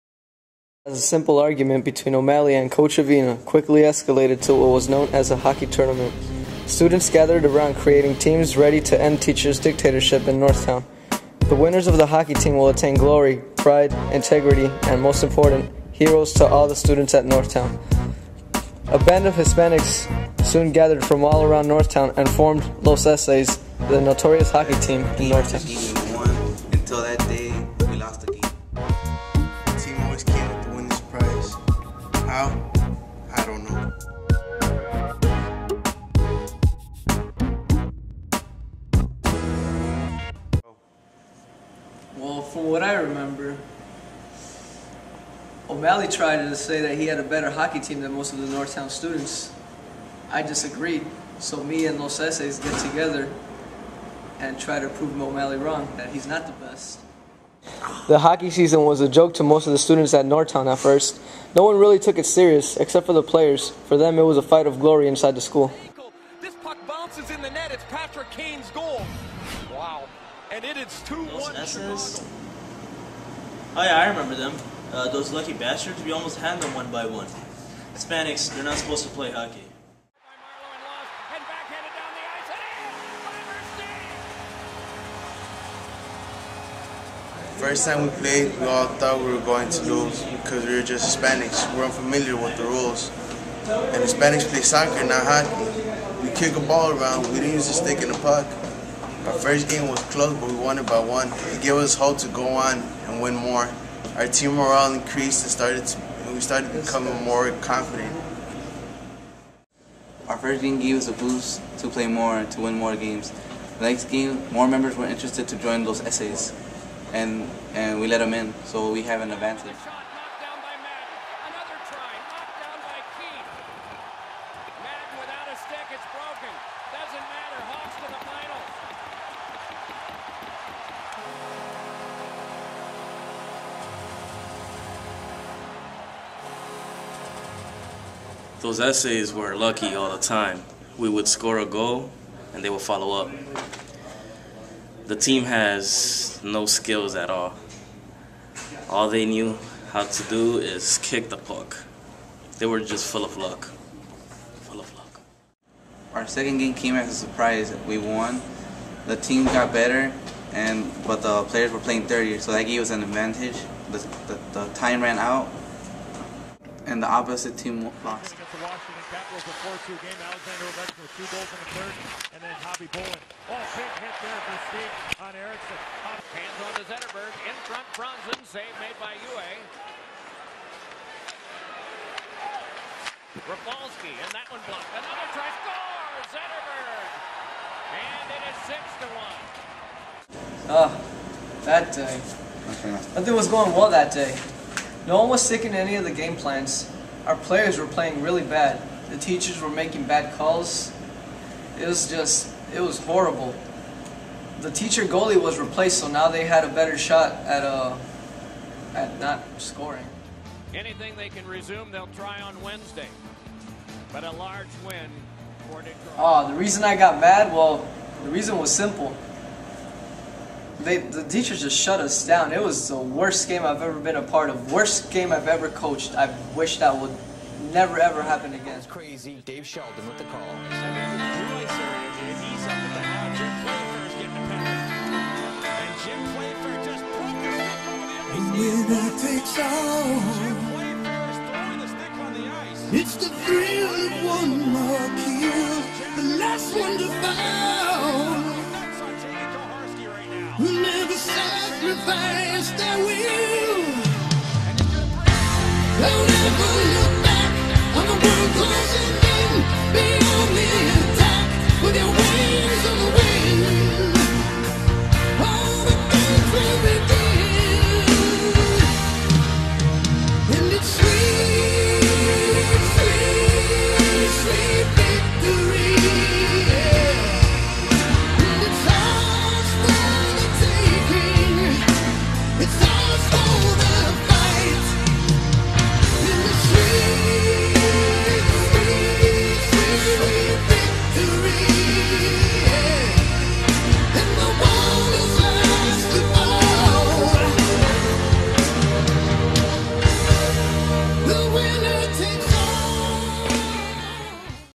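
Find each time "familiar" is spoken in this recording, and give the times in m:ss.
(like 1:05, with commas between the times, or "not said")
1:31.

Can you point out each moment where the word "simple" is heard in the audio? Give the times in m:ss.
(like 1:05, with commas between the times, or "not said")
0:01, 3:38.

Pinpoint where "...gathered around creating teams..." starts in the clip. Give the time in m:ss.
0:07.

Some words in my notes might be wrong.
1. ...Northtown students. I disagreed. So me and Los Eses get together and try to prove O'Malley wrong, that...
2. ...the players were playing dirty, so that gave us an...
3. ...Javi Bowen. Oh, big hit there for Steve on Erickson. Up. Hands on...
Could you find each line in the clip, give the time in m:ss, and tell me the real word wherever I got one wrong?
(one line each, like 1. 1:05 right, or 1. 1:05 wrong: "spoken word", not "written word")
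1. 0:48 right
2. 2:41 right
3. 2:52 right.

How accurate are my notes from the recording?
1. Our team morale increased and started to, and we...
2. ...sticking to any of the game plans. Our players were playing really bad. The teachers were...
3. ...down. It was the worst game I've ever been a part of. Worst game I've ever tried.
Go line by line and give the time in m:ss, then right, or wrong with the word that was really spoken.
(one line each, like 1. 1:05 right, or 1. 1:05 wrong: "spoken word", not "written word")
1. 1:44 right
2. 3:15 right
3. 3:42 wrong: "coached", not "tried".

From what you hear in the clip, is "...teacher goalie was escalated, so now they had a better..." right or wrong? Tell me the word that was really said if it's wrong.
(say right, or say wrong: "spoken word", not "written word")
wrong: "replaced", not "escalated".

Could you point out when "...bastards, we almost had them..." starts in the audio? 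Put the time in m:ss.
1:15.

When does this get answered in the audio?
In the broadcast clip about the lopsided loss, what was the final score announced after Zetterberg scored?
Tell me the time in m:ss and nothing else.
3:10.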